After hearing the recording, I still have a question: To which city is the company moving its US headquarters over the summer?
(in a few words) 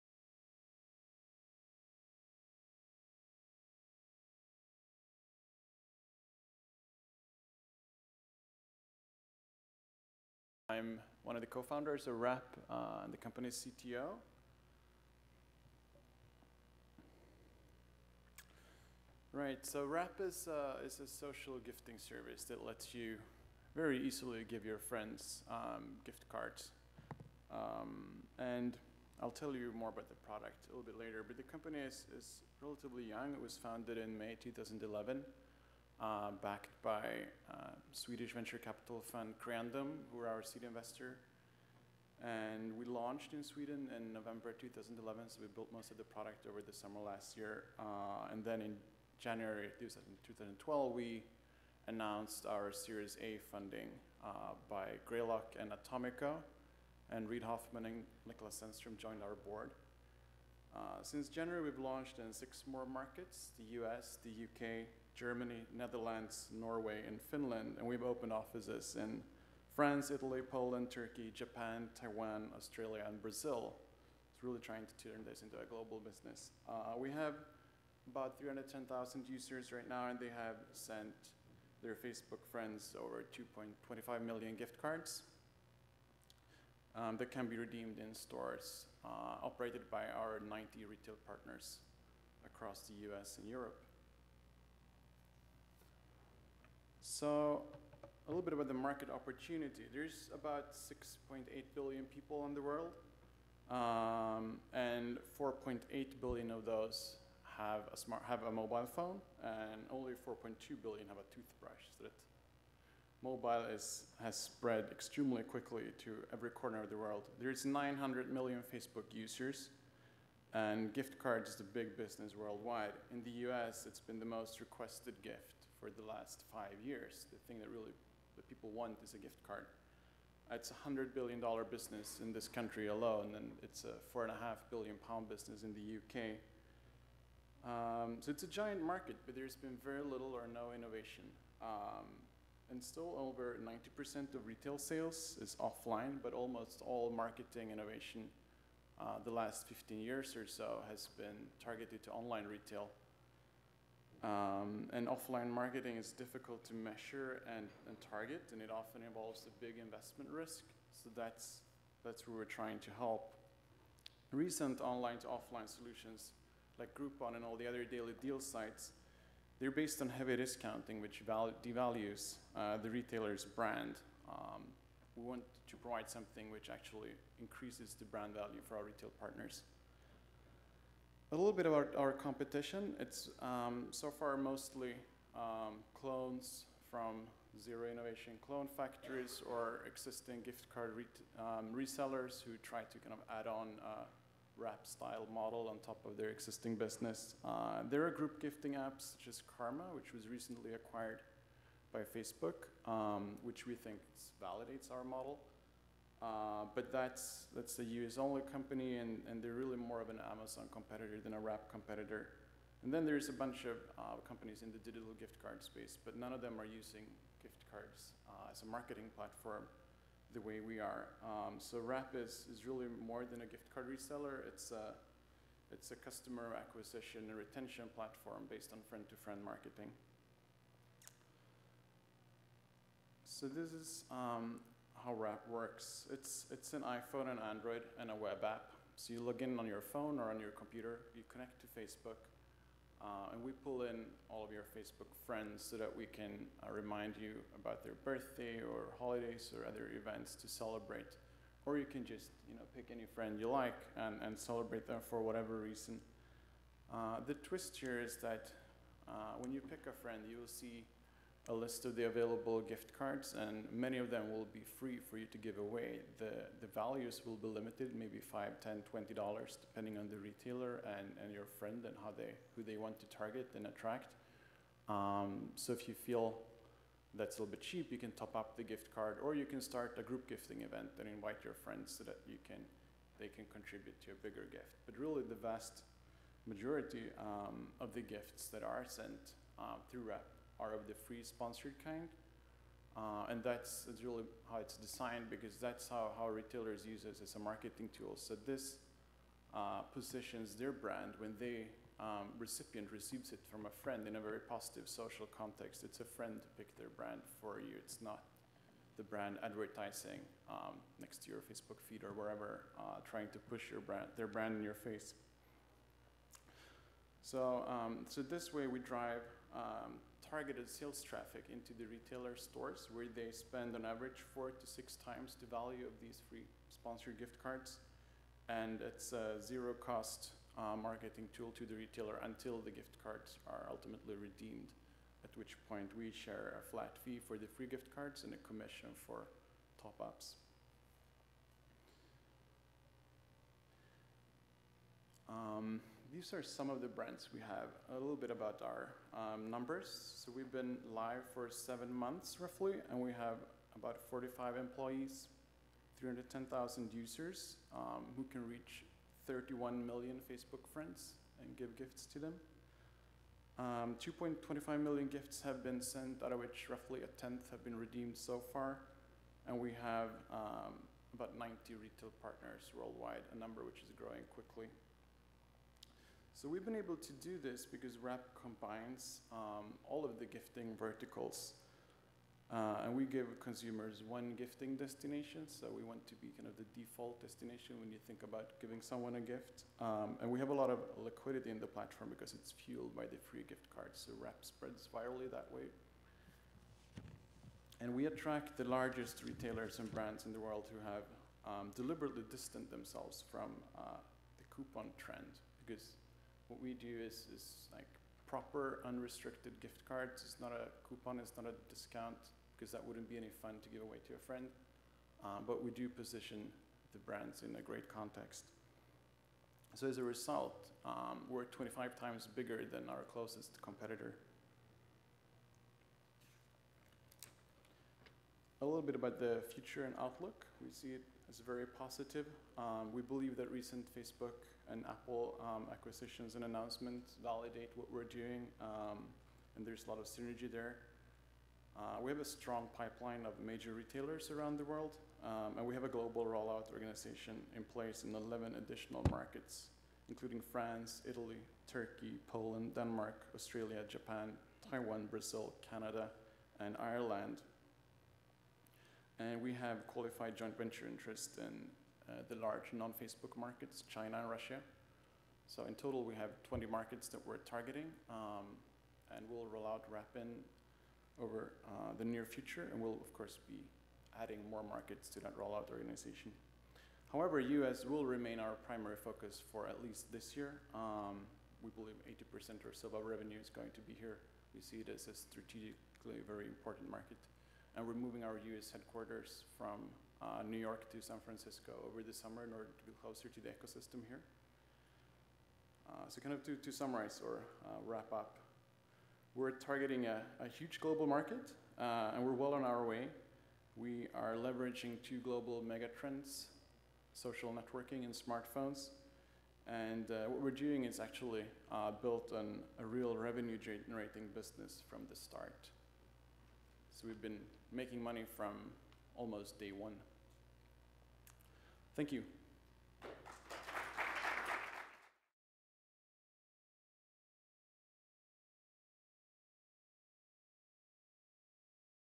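San Francisco.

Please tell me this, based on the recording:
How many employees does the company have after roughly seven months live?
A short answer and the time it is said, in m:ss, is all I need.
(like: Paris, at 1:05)
45, at 5:54.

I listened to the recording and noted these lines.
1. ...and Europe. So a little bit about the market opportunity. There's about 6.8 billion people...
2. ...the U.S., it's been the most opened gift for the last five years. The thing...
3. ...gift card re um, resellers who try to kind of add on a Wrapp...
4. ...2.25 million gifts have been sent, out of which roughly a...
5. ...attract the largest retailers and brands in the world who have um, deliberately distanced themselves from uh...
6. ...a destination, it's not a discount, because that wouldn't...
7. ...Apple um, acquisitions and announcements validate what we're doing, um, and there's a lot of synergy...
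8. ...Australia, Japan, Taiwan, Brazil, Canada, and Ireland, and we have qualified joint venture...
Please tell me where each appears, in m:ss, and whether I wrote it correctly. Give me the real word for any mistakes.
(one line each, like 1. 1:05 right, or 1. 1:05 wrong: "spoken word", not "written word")
1. 1:33 right
2. 2:03 wrong: "requested", not "opened"
3. 3:10 right
4. 6:03 right
5. 6:38 right
6. 6:50 wrong: "coupon", not "destination"
7. 7:14 right
8. 7:33 right.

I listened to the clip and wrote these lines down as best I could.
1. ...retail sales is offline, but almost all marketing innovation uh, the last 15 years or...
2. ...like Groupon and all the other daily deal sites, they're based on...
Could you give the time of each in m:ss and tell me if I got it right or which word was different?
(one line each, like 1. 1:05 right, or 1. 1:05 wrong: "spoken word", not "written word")
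1. 2:24 right
2. 2:46 right.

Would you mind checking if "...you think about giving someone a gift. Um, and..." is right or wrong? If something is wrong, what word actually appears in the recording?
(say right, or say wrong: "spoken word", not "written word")
right.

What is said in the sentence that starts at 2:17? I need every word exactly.
Um, so it's a giant market, but there's been very little or no innovation.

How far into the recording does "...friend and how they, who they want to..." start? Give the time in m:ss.
4:31.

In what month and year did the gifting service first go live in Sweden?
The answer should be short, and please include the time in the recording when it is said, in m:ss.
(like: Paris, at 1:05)
November 2011, at 0:44.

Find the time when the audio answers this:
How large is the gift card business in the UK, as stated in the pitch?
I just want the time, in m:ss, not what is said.
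2:14.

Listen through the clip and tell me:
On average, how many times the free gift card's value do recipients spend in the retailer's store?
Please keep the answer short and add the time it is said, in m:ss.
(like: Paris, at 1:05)
4 to 6 times, at 5:24.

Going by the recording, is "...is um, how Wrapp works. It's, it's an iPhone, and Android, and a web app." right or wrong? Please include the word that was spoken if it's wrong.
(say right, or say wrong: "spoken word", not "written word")
right.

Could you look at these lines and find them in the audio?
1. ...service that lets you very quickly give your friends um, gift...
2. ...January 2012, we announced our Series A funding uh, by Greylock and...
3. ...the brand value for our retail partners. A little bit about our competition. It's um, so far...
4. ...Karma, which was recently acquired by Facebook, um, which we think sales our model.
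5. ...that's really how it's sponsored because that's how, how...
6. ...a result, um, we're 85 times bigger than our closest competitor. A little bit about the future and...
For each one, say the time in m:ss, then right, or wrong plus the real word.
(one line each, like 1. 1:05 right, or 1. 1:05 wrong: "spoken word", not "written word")
1. 0:21 wrong: "easily", not "quickly"
2. 0:49 right
3. 2:57 right
4. 3:19 wrong: "validates", not "sales"
5. 4:53 wrong: "designed", not "sponsored"
6. 6:59 wrong: "25", not "85".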